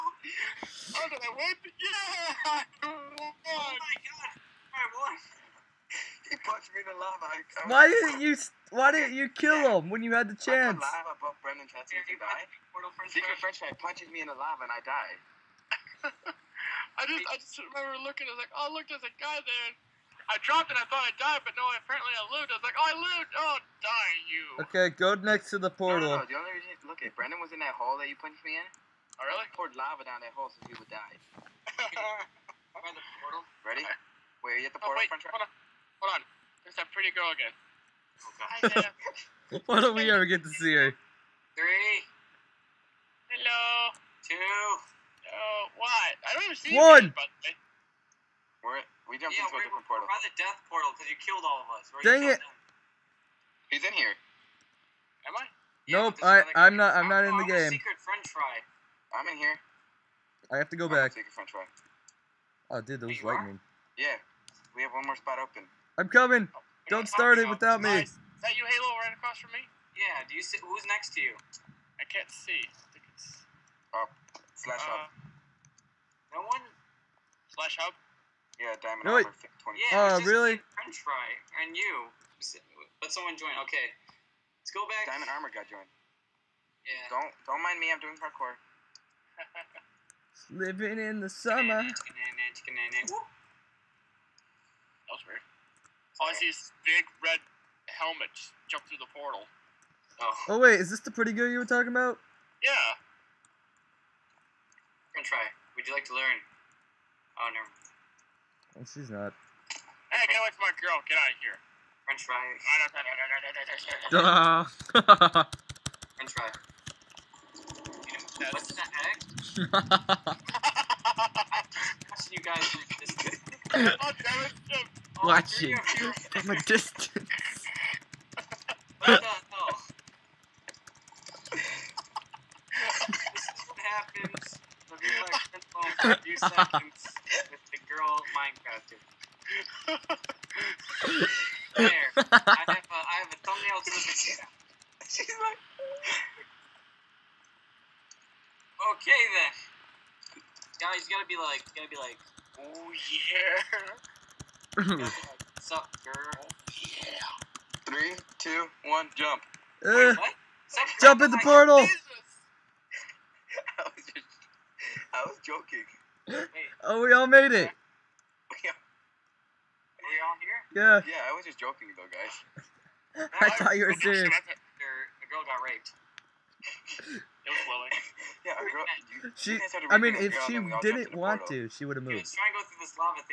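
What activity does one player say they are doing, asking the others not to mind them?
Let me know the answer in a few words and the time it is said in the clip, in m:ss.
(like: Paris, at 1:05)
Parkour, at 1:28.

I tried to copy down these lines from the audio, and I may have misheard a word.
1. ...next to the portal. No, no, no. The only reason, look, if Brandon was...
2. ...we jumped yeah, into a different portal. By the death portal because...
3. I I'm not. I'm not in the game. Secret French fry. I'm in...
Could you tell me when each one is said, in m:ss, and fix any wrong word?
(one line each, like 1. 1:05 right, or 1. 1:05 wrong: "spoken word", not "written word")
1. 0:25 right
2. 0:49 right
3. 0:56 right.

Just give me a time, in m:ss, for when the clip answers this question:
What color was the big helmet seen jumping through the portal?
1:37.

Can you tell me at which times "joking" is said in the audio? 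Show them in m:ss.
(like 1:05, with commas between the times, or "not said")
2:45, 2:51.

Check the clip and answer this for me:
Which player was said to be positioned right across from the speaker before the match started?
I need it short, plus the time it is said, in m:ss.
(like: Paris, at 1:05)
Halo, at 1:08.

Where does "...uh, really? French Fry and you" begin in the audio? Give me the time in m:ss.
1:20.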